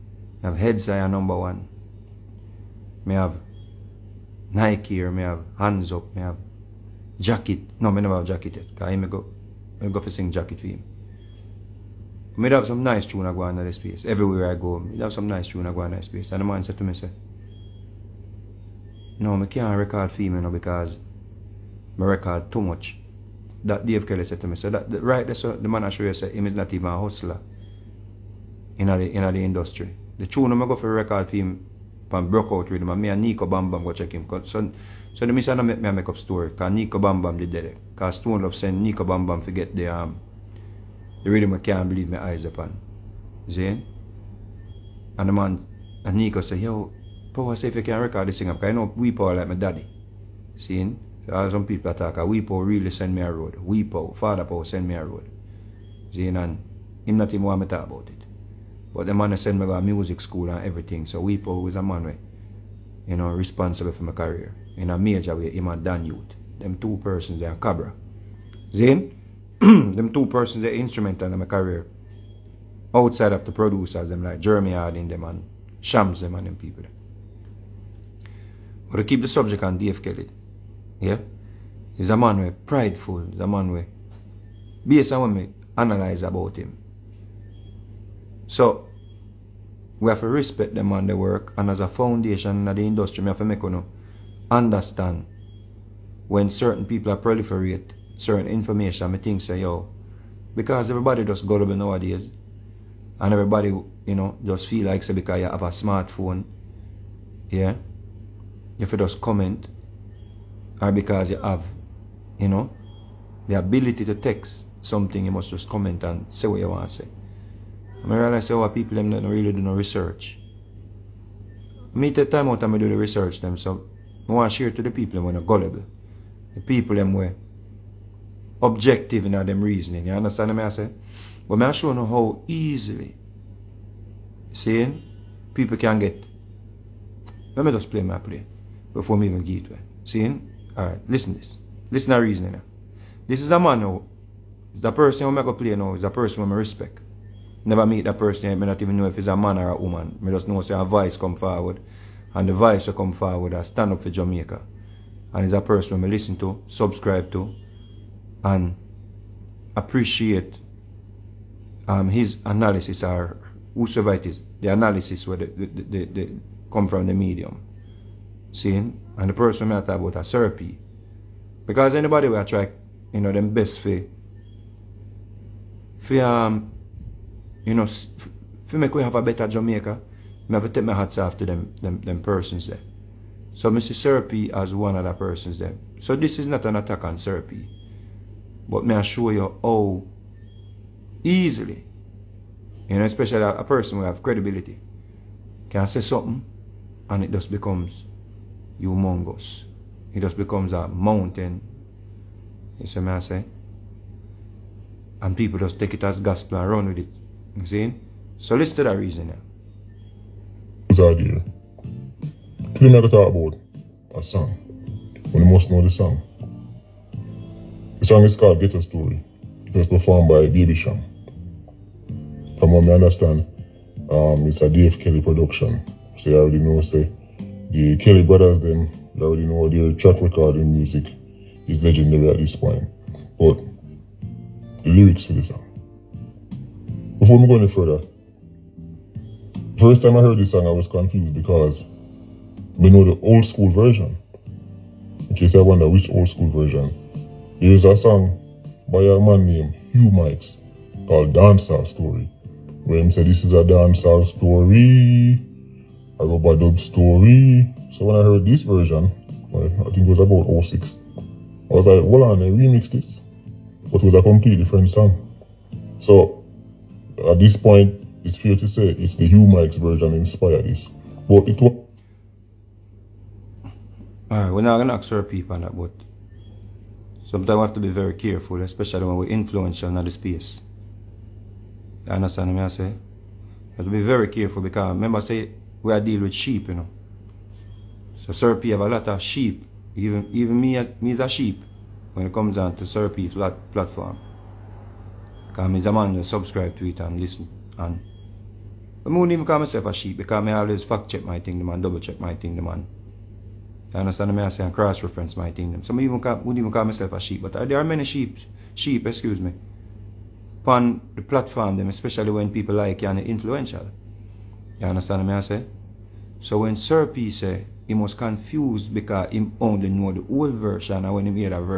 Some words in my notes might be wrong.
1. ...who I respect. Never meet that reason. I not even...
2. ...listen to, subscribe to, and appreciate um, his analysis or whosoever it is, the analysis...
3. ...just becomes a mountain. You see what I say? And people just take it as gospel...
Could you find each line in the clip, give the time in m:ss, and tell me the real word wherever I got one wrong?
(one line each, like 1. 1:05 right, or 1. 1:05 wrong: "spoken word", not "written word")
1. 2:26 wrong: "person", not "reason"
2. 2:36 right
3. 3:20 right.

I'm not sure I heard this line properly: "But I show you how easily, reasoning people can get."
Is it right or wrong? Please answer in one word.
wrong.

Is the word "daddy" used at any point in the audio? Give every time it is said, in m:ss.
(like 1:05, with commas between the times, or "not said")
0:49.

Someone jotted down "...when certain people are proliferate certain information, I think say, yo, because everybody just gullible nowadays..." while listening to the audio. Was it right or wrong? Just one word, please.
right.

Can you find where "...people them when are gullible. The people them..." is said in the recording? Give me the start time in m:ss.
2:04.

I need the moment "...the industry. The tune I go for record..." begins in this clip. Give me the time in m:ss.
0:29.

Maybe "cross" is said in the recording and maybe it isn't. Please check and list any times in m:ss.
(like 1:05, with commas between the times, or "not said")
5:04.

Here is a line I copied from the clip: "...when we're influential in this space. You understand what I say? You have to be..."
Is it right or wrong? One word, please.
right.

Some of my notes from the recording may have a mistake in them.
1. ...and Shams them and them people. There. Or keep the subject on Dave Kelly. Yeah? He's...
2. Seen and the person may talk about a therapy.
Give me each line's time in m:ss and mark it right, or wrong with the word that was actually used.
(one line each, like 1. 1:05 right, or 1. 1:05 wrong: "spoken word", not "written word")
1. 1:15 right
2. 2:48 right.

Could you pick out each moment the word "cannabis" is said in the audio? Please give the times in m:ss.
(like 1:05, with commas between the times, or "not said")
not said.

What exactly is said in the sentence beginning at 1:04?
In a major way, him and Dan Youth.